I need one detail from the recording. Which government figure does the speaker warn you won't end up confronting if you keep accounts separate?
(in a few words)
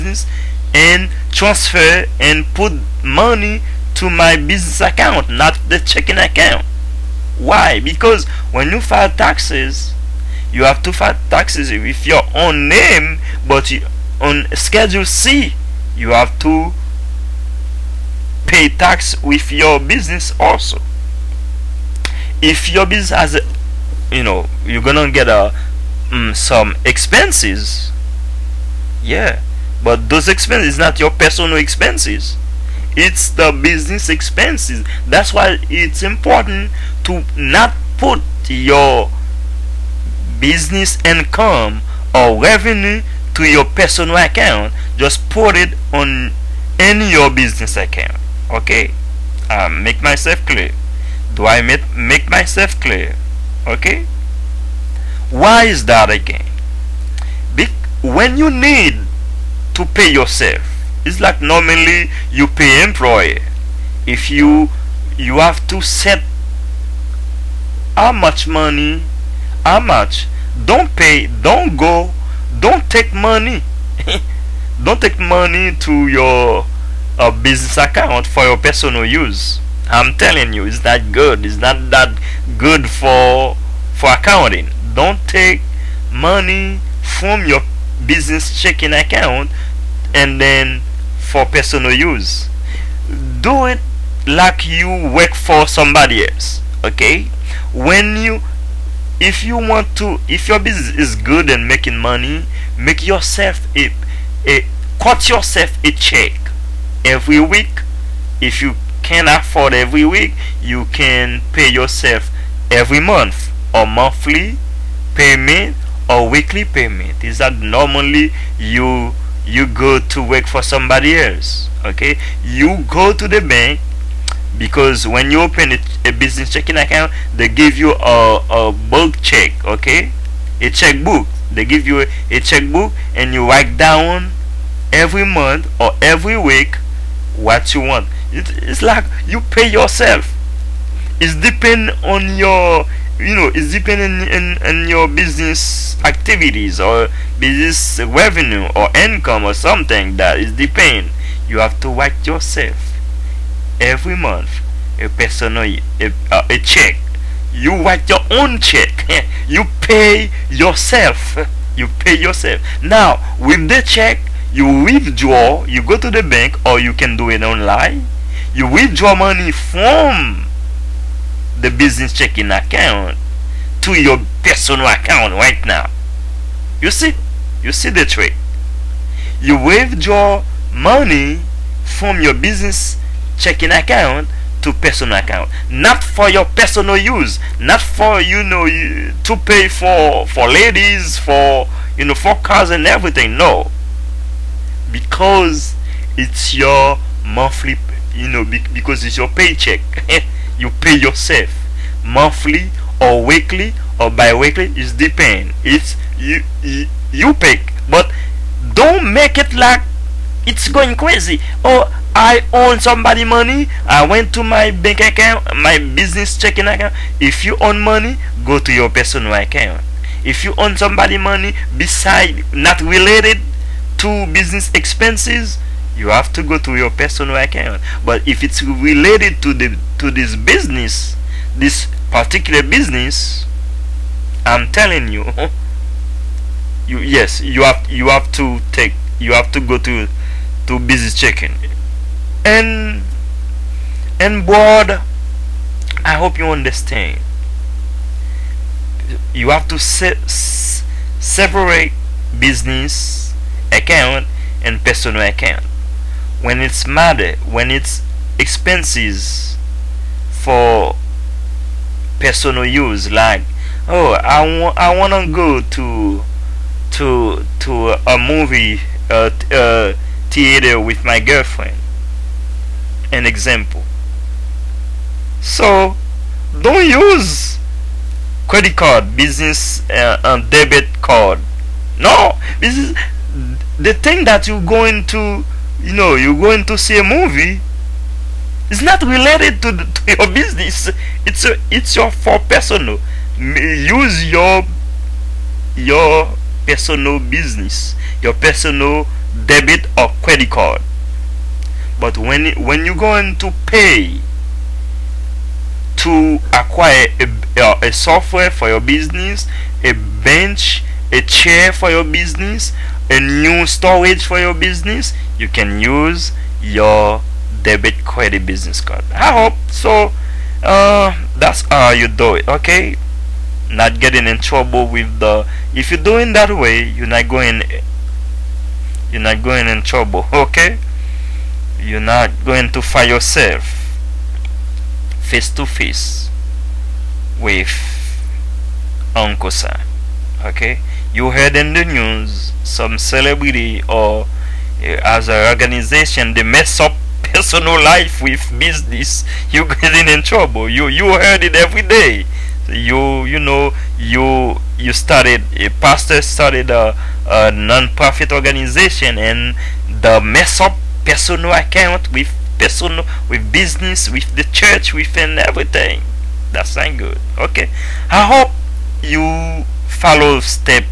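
Uncle Sam.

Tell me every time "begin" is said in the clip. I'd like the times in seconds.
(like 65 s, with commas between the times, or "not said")
not said.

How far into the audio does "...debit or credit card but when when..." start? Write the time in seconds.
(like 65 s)
299 s.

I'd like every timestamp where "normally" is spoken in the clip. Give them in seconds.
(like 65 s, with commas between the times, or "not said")
61 s, 117 s.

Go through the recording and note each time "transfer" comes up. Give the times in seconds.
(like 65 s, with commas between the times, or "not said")
1 s.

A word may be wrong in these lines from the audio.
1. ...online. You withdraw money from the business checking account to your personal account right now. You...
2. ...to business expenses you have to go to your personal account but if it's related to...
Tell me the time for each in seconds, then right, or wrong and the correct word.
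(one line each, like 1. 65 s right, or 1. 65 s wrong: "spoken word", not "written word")
1. 167 s right
2. 224 s right.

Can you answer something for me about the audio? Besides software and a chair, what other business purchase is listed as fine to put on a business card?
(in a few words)
A new storage.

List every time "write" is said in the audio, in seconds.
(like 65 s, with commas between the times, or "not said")
133 s, 151 s, 157 s.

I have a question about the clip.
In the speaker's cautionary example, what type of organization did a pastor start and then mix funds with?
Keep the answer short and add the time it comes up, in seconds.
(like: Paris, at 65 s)
Non-profit organization, at 357 s.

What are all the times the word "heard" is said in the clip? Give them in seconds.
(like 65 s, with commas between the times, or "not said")
341 s, 351 s.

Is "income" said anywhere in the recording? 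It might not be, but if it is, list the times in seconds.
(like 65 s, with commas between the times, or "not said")
41 s, 148 s.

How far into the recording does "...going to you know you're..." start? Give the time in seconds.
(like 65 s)
284 s.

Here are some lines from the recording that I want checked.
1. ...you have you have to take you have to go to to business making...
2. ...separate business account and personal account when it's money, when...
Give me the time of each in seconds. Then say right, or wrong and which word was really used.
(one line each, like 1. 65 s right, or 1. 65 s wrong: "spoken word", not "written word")
1. 237 s wrong: "checking", not "making"
2. 251 s right.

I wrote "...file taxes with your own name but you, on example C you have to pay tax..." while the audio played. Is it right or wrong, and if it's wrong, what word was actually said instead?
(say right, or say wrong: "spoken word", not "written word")
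wrong: "schedule", not "example".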